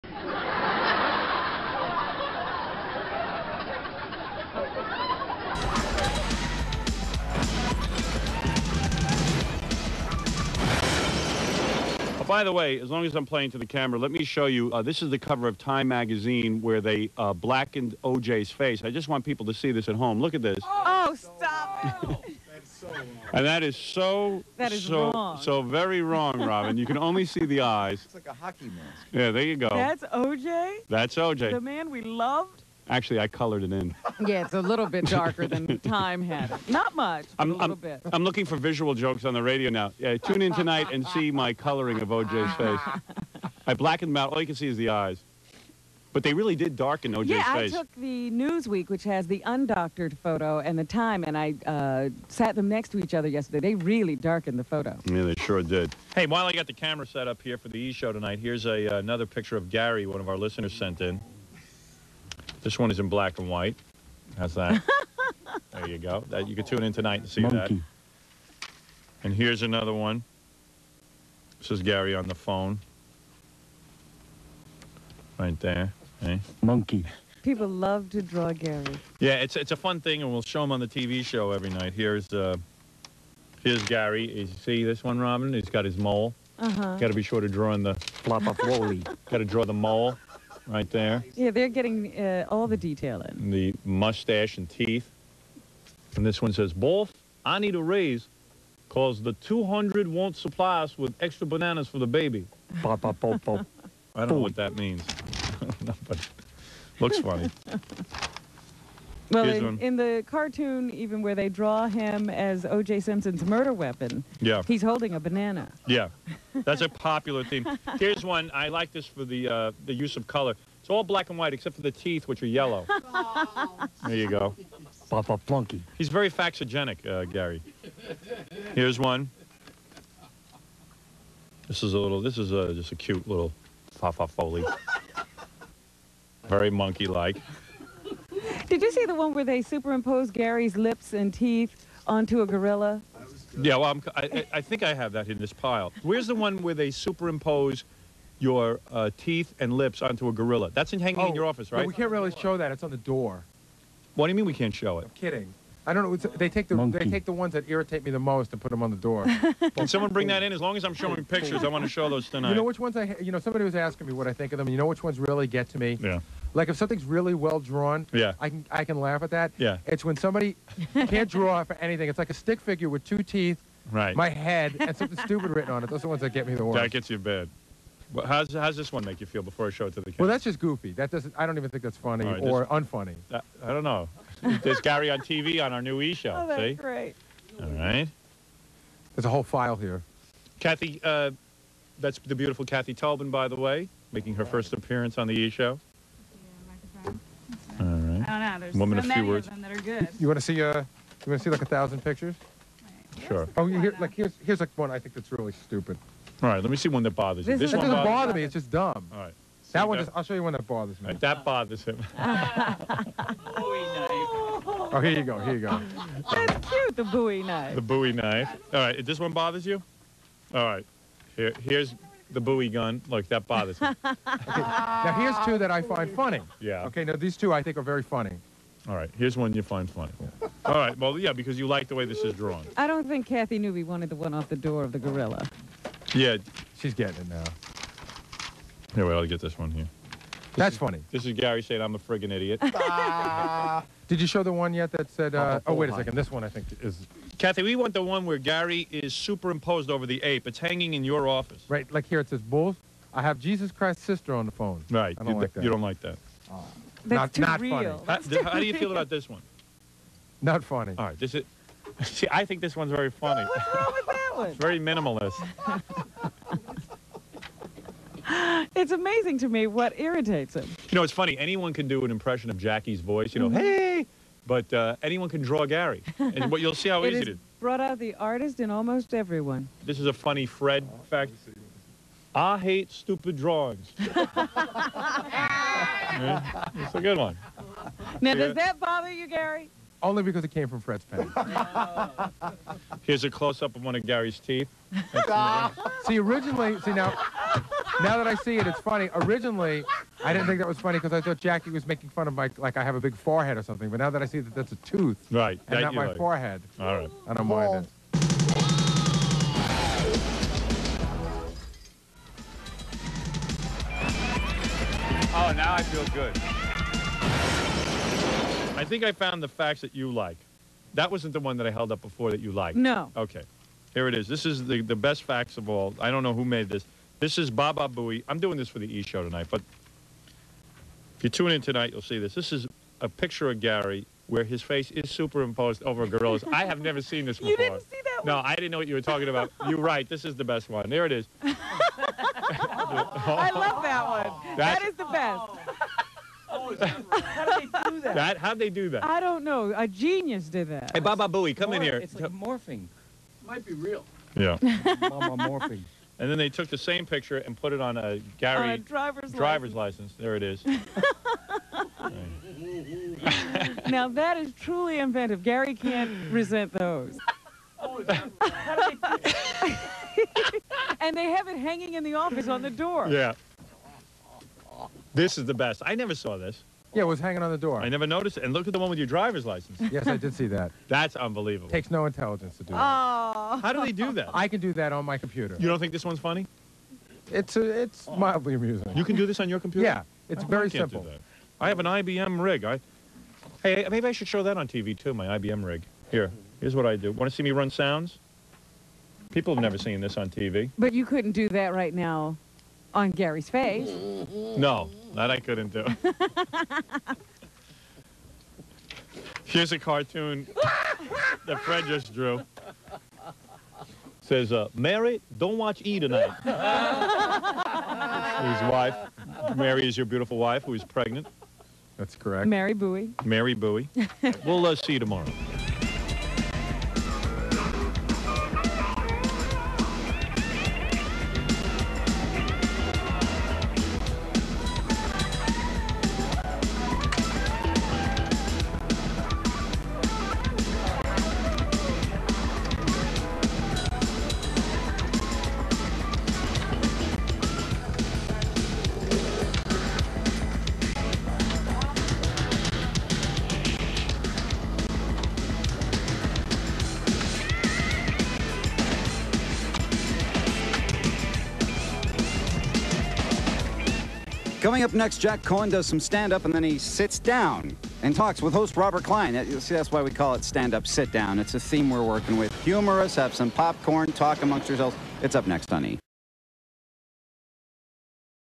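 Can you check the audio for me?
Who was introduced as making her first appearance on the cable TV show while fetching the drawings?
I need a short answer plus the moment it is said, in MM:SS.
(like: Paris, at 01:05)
Kathy Talbin, at 03:12.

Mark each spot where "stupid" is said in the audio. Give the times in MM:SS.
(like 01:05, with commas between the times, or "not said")
02:55, 03:25, 04:42.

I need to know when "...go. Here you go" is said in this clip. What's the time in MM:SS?
03:35.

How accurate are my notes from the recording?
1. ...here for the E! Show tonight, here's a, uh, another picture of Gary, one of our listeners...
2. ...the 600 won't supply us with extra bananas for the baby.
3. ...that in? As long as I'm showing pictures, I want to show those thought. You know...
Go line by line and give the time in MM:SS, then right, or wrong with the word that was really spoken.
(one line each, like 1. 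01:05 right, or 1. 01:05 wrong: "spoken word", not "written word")
1. 00:57 right
2. 01:39 wrong: "200", not "600"
3. 02:40 wrong: "tonight", not "thought".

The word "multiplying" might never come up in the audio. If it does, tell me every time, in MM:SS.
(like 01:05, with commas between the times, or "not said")
not said.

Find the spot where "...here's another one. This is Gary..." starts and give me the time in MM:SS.
01:09.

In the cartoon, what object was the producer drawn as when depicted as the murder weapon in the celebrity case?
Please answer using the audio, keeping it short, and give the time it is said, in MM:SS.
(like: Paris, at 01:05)
banana, at 01:55.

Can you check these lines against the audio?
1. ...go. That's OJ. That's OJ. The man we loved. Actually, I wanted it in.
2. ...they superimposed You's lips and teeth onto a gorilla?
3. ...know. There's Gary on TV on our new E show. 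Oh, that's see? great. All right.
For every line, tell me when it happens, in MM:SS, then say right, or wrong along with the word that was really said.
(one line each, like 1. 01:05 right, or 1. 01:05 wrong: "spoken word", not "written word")
1. 00:29 wrong: "colored", not "wanted"
2. 02:19 wrong: "Gary", not "You"
3. 03:03 right.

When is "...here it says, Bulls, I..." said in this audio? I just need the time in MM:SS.
04:12.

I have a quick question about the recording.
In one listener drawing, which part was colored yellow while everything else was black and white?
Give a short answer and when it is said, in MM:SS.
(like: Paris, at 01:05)
the teeth, at 02:01.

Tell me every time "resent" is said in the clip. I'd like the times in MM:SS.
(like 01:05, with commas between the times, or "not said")
06:06.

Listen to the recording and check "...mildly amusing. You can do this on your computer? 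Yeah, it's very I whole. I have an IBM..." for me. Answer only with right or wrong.
wrong.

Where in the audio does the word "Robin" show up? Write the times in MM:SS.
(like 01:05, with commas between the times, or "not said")
00:26, 01:25.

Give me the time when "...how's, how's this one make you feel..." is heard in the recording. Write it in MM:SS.
02:58.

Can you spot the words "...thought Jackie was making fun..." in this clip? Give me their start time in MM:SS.
05:01.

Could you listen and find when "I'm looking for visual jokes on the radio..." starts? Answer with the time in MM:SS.
00:38.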